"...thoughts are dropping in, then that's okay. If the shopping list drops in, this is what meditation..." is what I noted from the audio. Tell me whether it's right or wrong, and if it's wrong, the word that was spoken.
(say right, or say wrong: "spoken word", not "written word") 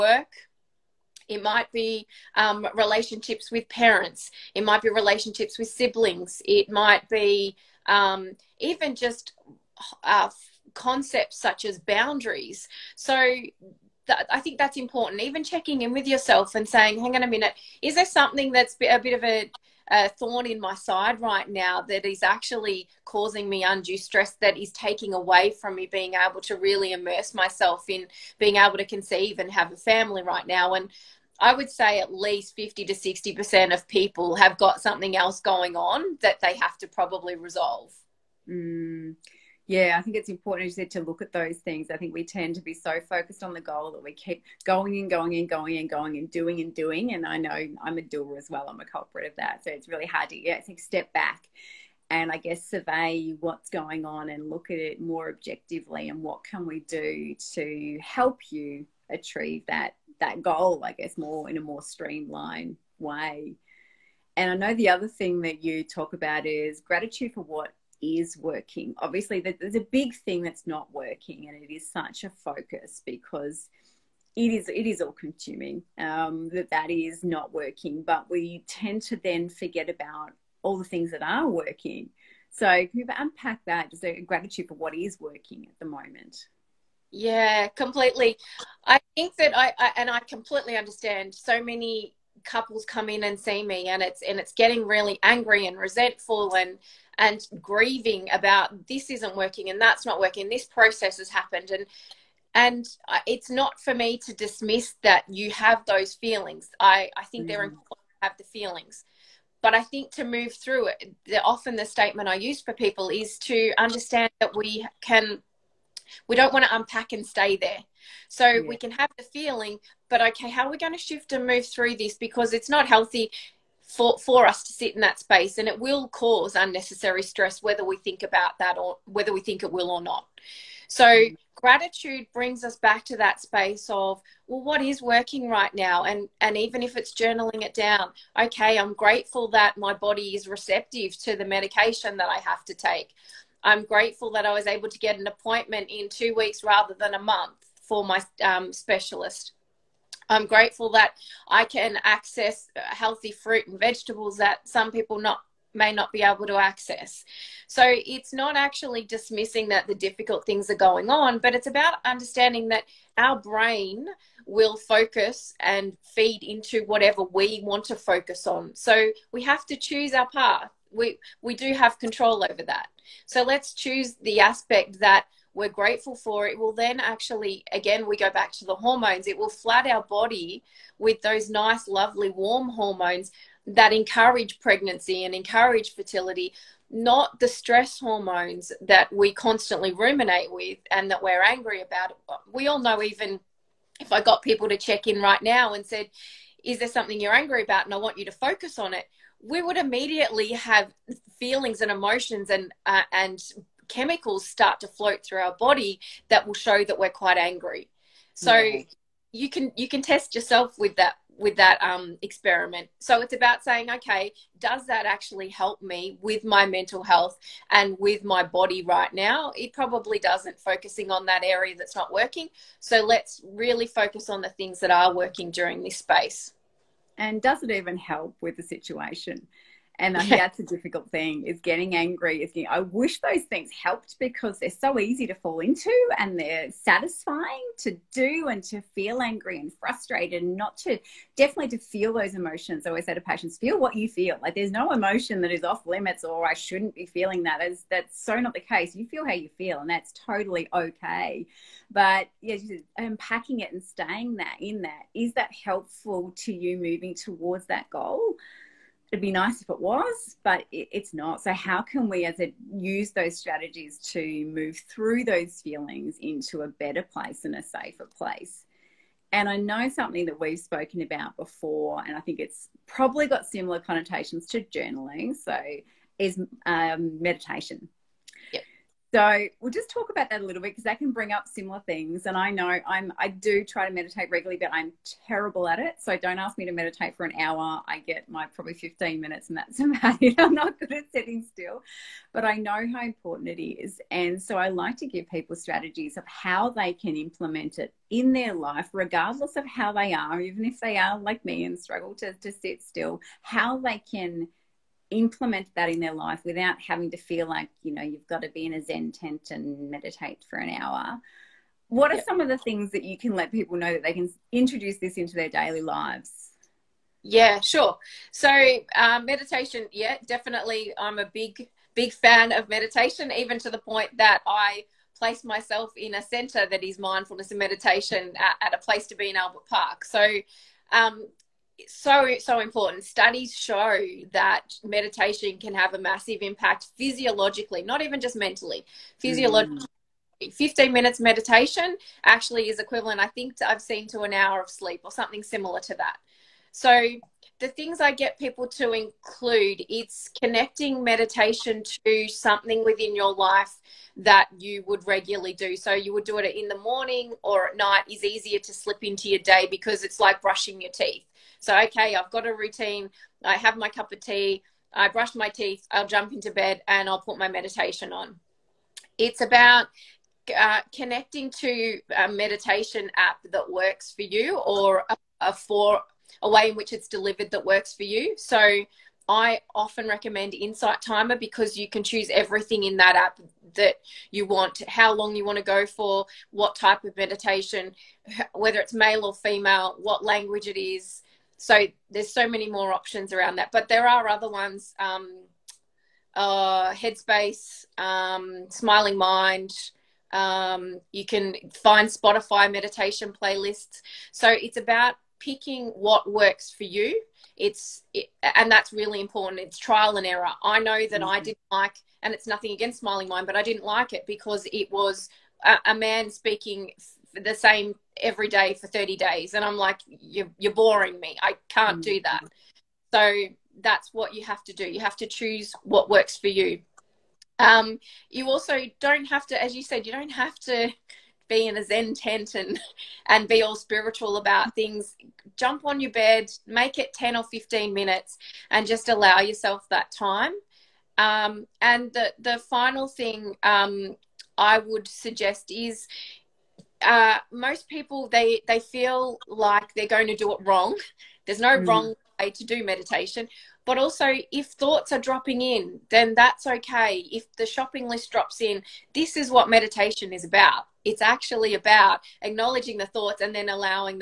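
right.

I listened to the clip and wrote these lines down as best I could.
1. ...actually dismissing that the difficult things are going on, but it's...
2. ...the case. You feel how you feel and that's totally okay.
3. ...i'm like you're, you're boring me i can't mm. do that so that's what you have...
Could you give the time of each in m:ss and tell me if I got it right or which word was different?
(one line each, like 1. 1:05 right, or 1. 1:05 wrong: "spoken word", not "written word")
1. 2:38 right
2. 4:08 right
3. 6:59 right.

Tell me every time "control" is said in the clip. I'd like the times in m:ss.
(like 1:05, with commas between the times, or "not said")
2:51.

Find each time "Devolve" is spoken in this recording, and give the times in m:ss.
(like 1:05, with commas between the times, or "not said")
not said.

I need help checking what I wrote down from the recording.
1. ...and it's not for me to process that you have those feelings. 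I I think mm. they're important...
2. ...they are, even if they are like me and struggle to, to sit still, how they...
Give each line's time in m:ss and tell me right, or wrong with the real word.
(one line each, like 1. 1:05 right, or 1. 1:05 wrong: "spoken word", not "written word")
1. 1:42 wrong: "dismiss", not "process"
2. 4:59 right.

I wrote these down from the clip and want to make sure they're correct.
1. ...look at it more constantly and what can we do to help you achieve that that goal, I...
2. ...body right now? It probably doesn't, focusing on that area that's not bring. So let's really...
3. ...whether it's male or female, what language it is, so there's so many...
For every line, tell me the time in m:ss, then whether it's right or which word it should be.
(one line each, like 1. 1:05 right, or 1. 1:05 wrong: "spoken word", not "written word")
1. 0:54 wrong: "objectively", not "constantly"
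2. 3:38 wrong: "working", not "bring"
3. 6:28 right.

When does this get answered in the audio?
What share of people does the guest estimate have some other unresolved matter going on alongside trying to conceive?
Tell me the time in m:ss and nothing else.
0:32.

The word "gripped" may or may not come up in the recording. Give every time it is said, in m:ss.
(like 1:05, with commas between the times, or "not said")
not said.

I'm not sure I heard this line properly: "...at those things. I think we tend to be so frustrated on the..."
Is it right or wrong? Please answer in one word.
wrong.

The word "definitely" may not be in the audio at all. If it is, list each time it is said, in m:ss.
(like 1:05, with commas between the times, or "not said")
4:01, 5:20.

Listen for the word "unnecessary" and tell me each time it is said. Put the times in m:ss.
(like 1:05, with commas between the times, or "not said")
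2:06.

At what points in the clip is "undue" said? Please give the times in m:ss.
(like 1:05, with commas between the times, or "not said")
0:23.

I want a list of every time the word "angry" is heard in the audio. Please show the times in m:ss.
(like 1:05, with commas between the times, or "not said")
1:35, 3:11, 3:17, 3:27, 3:51, 3:59.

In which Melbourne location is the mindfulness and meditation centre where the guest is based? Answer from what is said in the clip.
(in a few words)
Albert Park.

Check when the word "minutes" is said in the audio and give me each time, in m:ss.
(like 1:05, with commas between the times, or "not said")
0:17, 4:49, 5:40, 7:17.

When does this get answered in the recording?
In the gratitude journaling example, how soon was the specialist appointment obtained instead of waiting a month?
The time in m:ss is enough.
2:26.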